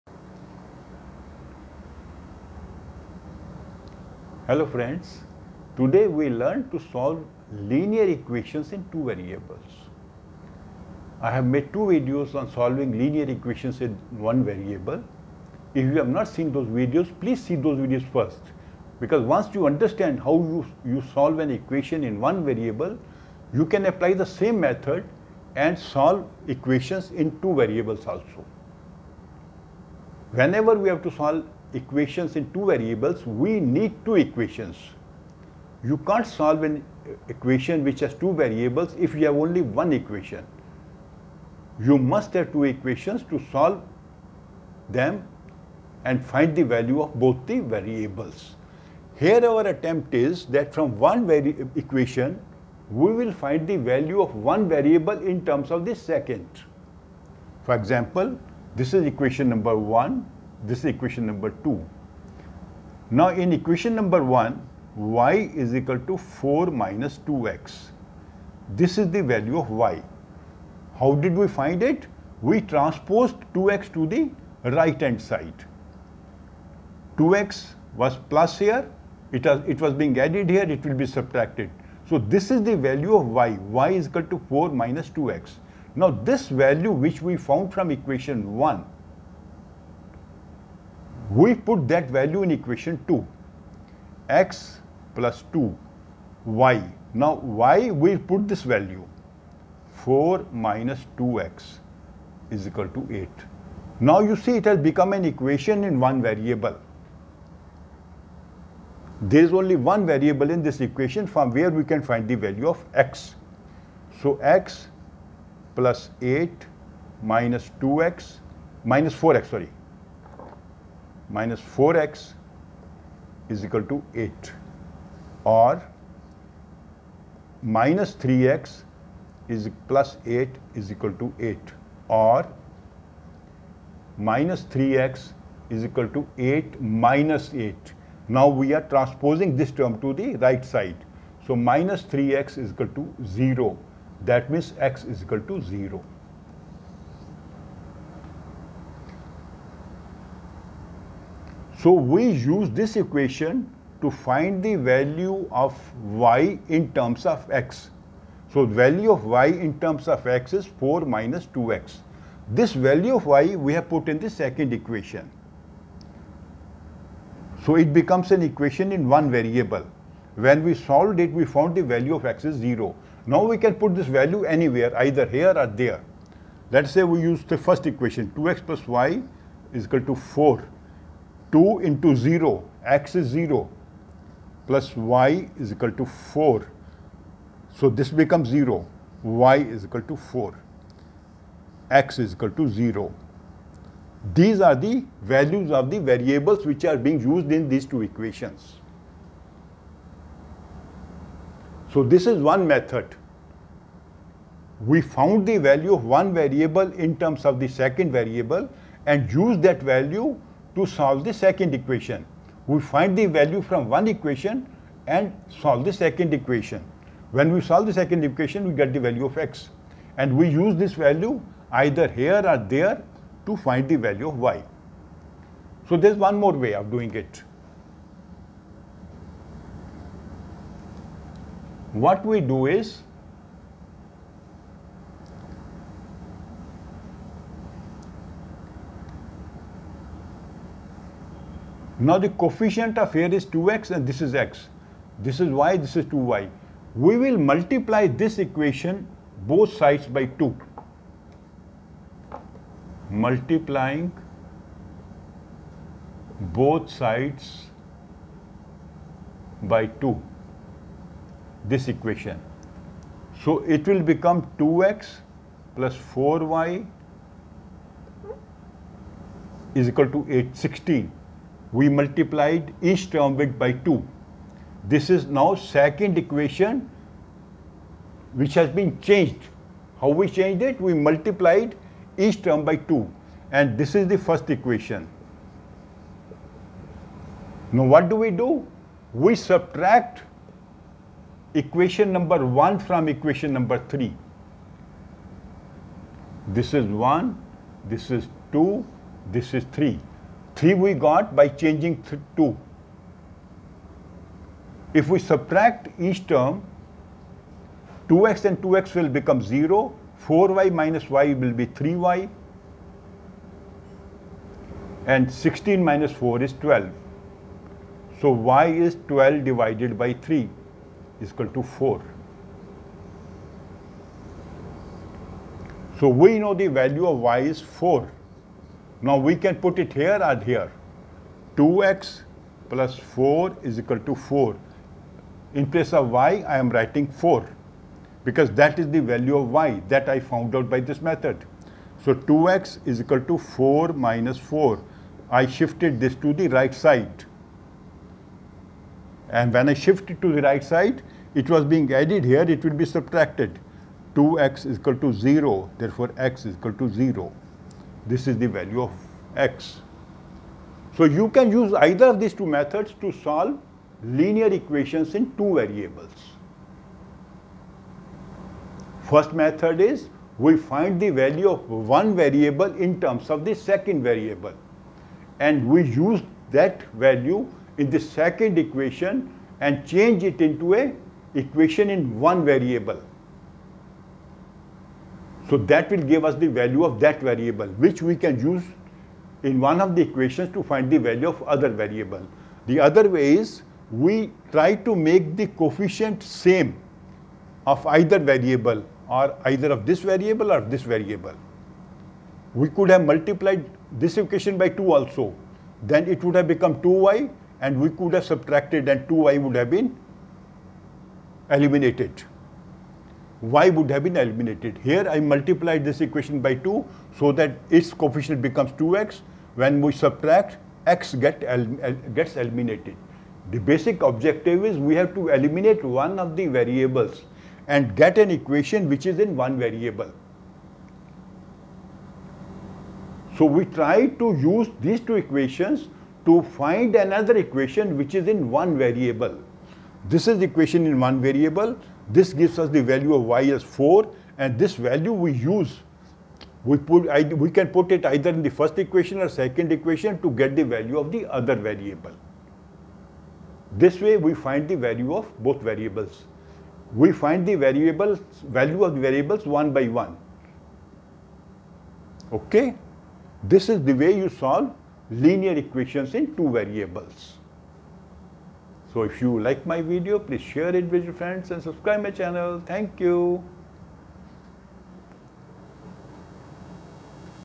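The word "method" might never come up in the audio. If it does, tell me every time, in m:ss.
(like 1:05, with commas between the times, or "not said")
0:24, 3:22, 5:41, 6:02, 6:09.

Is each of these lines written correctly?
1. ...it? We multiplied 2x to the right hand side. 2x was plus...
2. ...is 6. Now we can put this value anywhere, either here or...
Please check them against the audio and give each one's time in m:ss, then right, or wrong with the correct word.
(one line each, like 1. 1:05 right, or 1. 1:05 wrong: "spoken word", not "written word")
1. 1:11 wrong: "transposed", not "multiplied"
2. 2:52 wrong: "0", not "6".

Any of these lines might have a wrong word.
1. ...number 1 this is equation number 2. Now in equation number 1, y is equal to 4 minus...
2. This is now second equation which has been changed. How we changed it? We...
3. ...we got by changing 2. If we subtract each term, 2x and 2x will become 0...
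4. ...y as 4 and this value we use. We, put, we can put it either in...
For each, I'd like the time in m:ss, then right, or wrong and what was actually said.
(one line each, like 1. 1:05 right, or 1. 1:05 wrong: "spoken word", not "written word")
1. 0:59 right
2. 4:34 right
3. 5:00 right
4. 7:23 right.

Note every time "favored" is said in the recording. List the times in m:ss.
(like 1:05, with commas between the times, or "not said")
not said.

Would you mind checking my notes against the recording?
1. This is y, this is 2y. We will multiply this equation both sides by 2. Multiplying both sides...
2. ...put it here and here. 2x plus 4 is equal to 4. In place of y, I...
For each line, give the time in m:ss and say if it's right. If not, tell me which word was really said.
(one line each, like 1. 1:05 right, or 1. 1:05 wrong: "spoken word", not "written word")
1. 4:05 right
2. 5:29 right.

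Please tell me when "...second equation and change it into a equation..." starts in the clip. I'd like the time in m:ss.
6:17.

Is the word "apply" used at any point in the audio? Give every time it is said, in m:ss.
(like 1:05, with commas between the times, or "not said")
0:23.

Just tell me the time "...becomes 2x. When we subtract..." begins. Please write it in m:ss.
6:58.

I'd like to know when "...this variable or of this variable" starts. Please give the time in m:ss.
6:39.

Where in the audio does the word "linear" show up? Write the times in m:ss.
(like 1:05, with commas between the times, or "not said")
0:07, 0:12, 6:04, 7:45.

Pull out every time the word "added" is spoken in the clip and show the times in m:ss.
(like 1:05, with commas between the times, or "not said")
1:20, 5:51.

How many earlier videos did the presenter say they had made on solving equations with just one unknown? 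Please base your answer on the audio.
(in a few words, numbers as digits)
2.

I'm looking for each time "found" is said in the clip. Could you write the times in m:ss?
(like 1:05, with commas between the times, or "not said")
1:27, 2:51, 3:25, 5:40.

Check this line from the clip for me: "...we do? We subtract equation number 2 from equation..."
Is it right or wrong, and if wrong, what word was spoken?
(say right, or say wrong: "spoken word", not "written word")
wrong: "1", not "2".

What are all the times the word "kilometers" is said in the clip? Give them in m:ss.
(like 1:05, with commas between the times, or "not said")
not said.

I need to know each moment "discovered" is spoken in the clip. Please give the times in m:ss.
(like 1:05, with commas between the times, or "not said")
not said.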